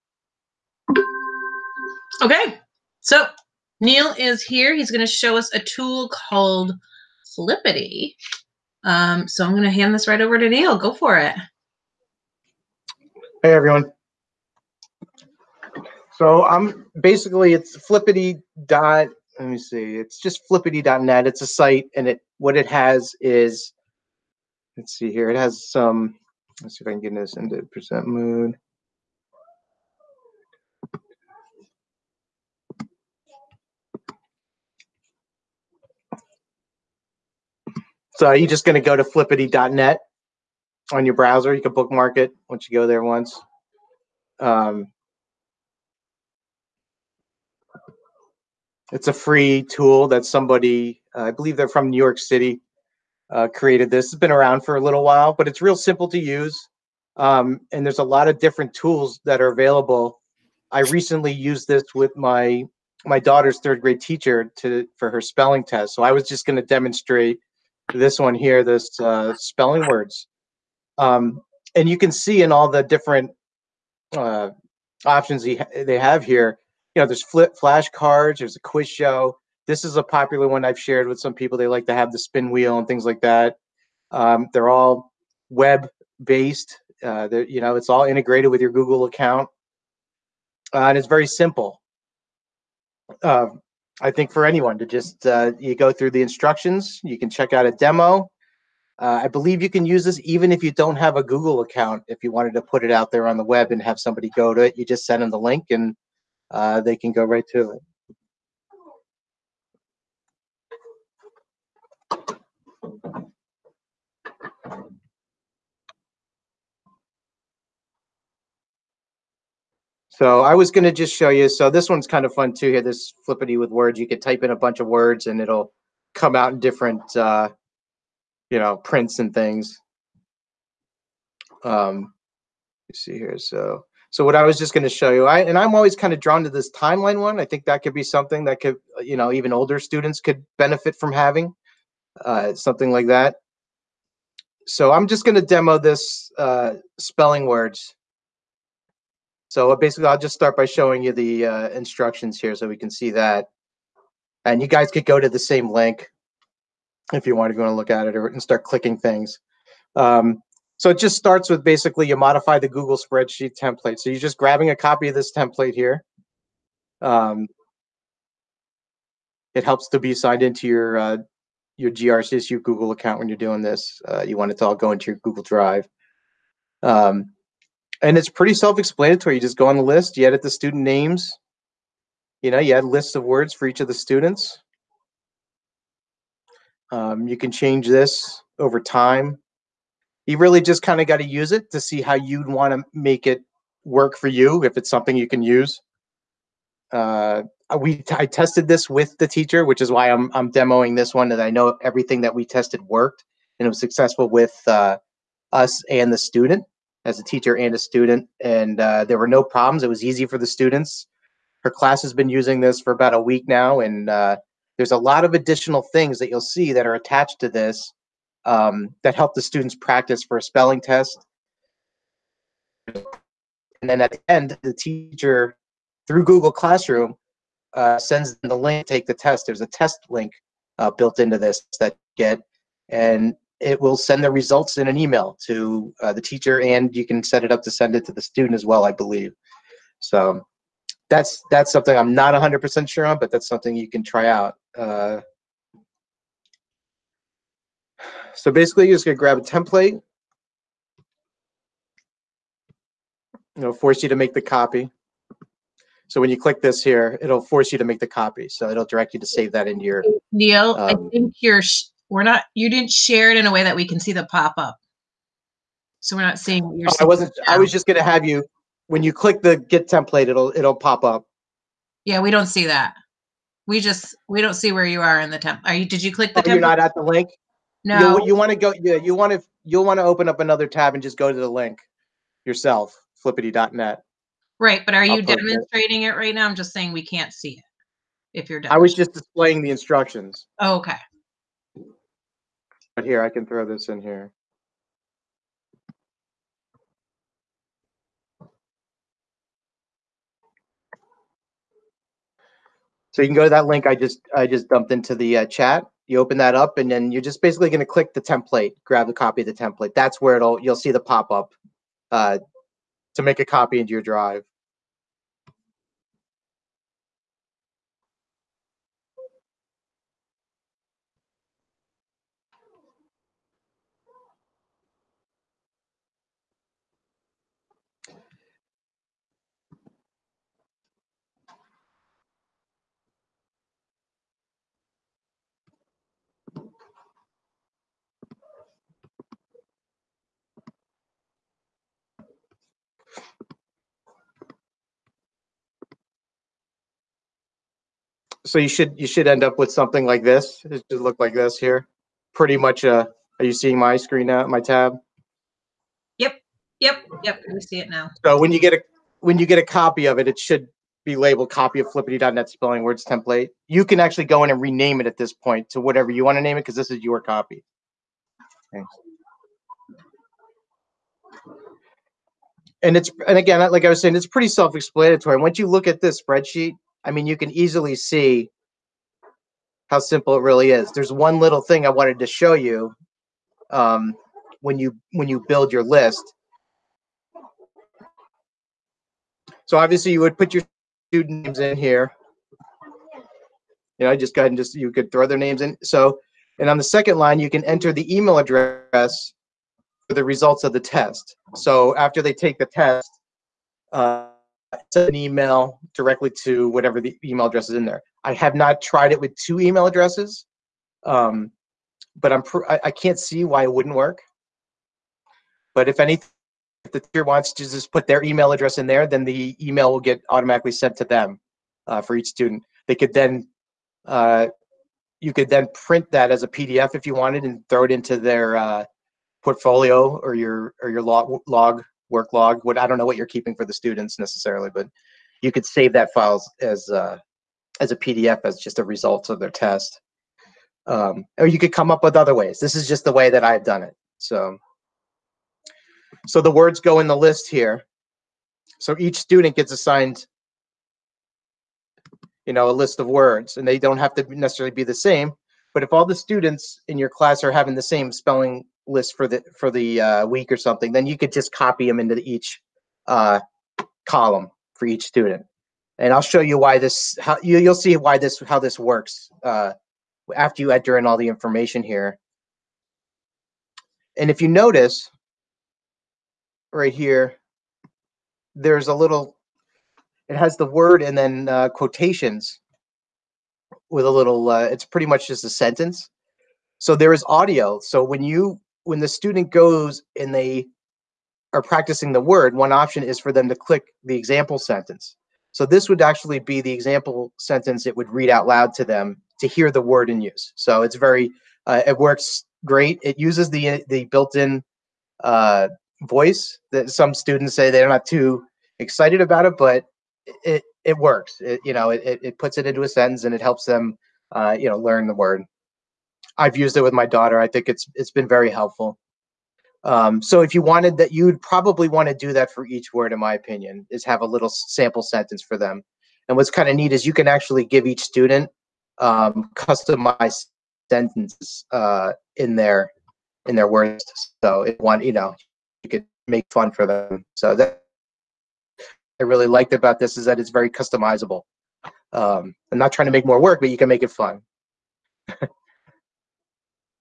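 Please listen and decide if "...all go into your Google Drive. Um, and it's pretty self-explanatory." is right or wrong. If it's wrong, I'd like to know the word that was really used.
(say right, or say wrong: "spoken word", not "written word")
right.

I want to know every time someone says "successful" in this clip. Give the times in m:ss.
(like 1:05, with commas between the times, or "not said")
3:23.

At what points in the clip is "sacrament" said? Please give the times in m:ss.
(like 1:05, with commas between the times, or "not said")
not said.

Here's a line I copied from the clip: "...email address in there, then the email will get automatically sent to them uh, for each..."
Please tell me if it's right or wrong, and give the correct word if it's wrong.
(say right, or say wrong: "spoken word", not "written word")
right.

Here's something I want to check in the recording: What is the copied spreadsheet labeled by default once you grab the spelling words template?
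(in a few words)
Copy of flippity.net spelling words template.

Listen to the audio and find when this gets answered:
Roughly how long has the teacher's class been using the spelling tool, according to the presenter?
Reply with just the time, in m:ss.
3:32.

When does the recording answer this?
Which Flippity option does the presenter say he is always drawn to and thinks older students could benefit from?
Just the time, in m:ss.
2:16.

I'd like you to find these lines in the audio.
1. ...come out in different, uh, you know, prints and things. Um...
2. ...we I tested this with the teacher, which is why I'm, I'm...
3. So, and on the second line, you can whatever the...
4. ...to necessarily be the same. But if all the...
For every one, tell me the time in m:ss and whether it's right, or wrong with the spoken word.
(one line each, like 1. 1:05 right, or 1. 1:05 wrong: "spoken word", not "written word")
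1. 2:06 right
2. 3:17 right
3. 6:35 wrong: "enter", not "whatever"
4. 7:34 right.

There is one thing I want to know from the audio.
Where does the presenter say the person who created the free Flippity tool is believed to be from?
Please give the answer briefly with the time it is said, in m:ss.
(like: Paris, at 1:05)
New York City, at 0:51.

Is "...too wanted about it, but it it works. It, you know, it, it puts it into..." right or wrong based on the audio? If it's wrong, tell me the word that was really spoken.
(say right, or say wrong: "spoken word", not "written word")
wrong: "excited", not "wanted".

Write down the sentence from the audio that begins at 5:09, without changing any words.
That's where it'll you'll see the pop up uh, to make a copy into your drive.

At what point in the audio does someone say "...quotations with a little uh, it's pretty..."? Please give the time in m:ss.
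8:01.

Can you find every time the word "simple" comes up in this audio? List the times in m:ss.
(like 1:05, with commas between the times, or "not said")
0:55, 1:31, 6:20.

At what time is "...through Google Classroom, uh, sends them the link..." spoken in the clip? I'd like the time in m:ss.
3:46.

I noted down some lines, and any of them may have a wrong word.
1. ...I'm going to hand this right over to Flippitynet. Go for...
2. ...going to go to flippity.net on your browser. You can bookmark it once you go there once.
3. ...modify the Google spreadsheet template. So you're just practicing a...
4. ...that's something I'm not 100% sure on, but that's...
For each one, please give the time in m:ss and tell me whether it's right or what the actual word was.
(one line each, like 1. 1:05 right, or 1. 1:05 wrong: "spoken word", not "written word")
1. 0:09 wrong: "Neil", not "Flippitynet"
2. 0:38 right
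3. 2:42 wrong: "grabbing", not "practicing"
4. 4:01 right.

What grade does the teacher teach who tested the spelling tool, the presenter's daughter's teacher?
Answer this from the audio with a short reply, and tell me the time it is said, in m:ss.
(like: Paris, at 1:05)
Third grade, at 1:03.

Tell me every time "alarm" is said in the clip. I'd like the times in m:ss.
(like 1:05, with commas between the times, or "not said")
not said.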